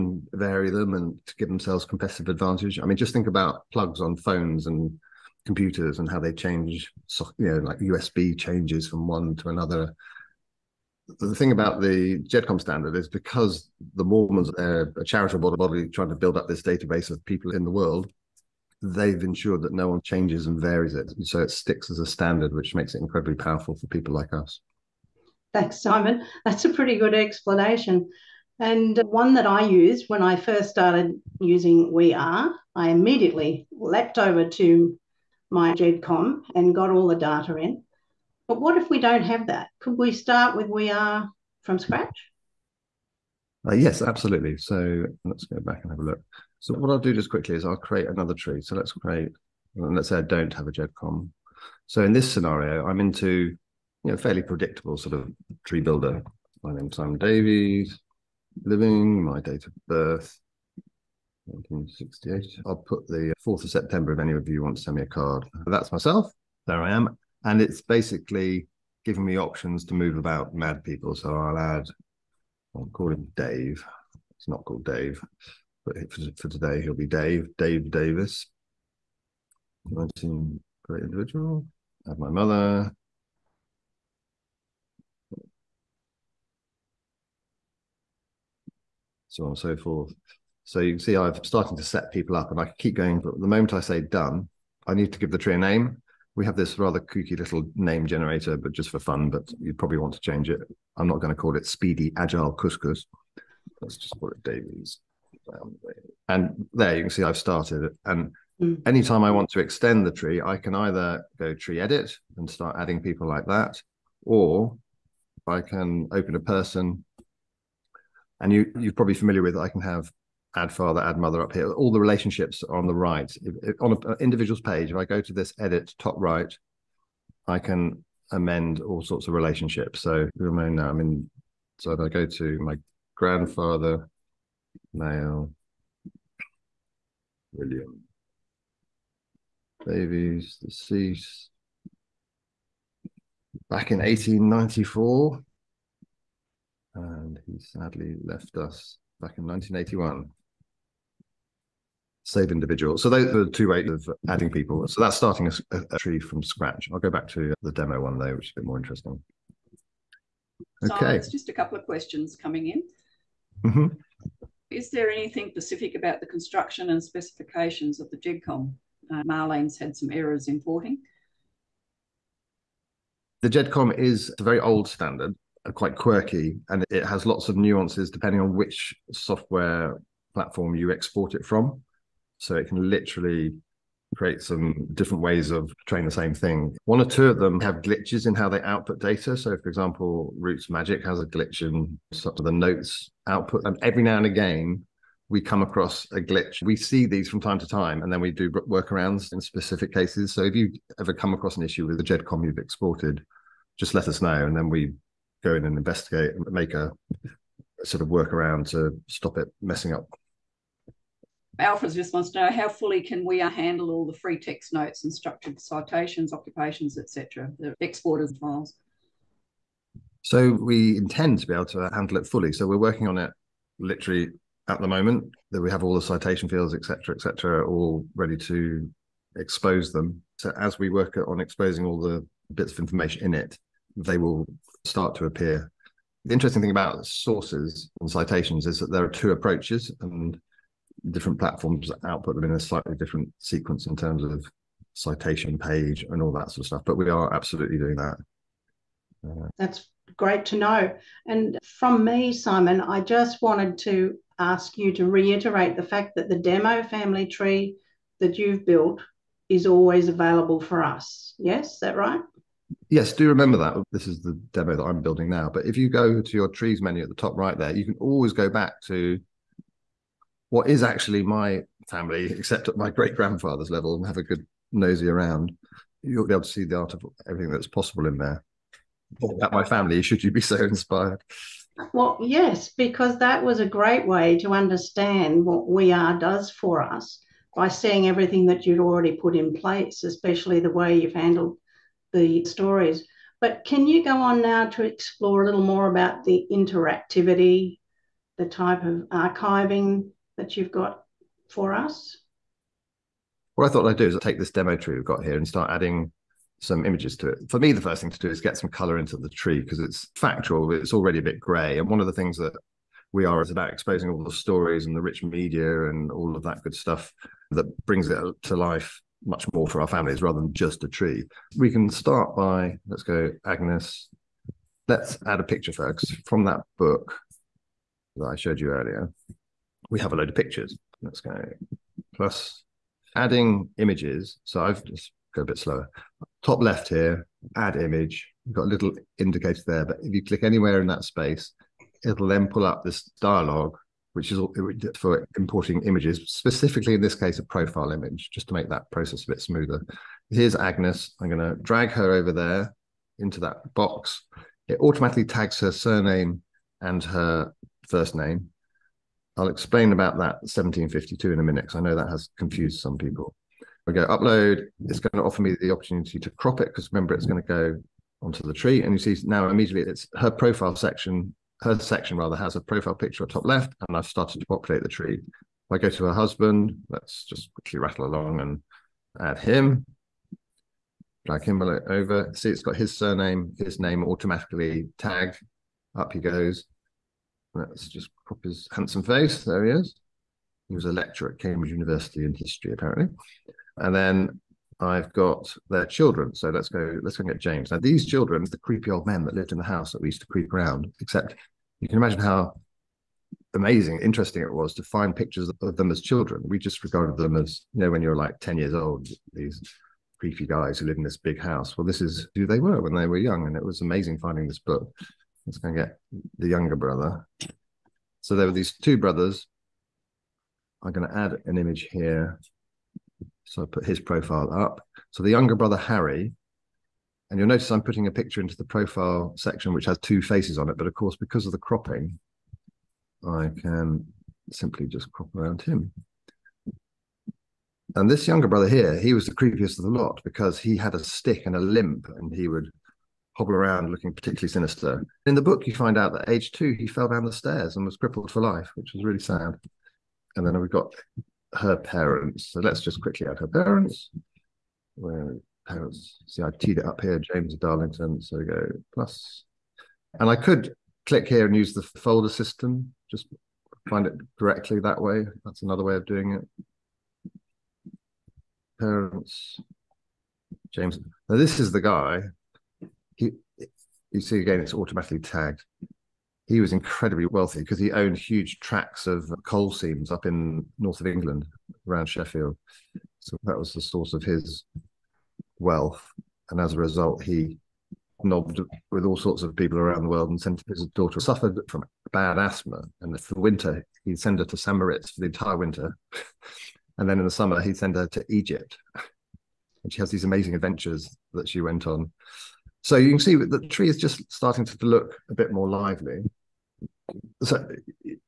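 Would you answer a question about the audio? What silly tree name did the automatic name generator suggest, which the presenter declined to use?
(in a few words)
Speedy Agile Couscous.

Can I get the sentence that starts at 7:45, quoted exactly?
That's another way of doing it.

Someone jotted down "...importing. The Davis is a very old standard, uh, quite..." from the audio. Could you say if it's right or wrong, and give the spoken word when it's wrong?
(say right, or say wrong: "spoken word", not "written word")
wrong: "GEDCOM", not "Davis".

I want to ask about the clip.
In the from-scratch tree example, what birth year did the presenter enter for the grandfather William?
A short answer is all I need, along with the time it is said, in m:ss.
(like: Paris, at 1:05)
1894, at 2:23.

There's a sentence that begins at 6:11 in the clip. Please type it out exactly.
Her section rather has a profile picture at top left, and I've started to populate the tree.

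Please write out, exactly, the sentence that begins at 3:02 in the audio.
So it can literally create some different ways of trying the same thing.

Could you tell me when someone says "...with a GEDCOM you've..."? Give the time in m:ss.
3:21.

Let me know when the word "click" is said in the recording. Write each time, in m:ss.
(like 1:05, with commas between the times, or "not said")
5:40, 7:41.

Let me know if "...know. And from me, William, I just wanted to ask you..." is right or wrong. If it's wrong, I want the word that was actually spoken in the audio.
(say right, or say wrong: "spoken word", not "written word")
wrong: "Simon", not "William".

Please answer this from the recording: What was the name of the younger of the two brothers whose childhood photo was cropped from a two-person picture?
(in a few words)
Harry.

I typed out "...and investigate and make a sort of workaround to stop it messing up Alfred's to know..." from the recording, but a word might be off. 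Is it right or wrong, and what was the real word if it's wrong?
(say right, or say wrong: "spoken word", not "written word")
right.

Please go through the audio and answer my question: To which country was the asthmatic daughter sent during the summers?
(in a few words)
Egypt.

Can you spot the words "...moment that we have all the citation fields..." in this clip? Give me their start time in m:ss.
3:44.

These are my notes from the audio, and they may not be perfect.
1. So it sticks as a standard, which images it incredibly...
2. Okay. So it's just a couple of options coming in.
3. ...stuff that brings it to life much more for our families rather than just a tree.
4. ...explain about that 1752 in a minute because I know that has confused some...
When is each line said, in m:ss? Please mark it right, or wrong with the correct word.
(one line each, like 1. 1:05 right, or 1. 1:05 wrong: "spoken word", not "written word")
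1. 0:21 wrong: "makes", not "images"
2. 2:40 wrong: "questions", not "options"
3. 5:16 right
4. 5:59 right.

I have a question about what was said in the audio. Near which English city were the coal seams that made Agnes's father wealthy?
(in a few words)
Sheffield.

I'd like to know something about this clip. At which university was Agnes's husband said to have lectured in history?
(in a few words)
Cambridge University.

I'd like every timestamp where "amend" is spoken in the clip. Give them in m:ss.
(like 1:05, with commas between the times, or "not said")
2:08.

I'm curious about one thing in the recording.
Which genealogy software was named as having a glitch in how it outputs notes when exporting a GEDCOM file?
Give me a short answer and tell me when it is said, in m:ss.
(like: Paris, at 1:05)
RootsMagic, at 3:10.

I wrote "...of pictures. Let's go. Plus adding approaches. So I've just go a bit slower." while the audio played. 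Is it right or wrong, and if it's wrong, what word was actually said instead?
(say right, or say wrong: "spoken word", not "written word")
wrong: "images", not "approaches".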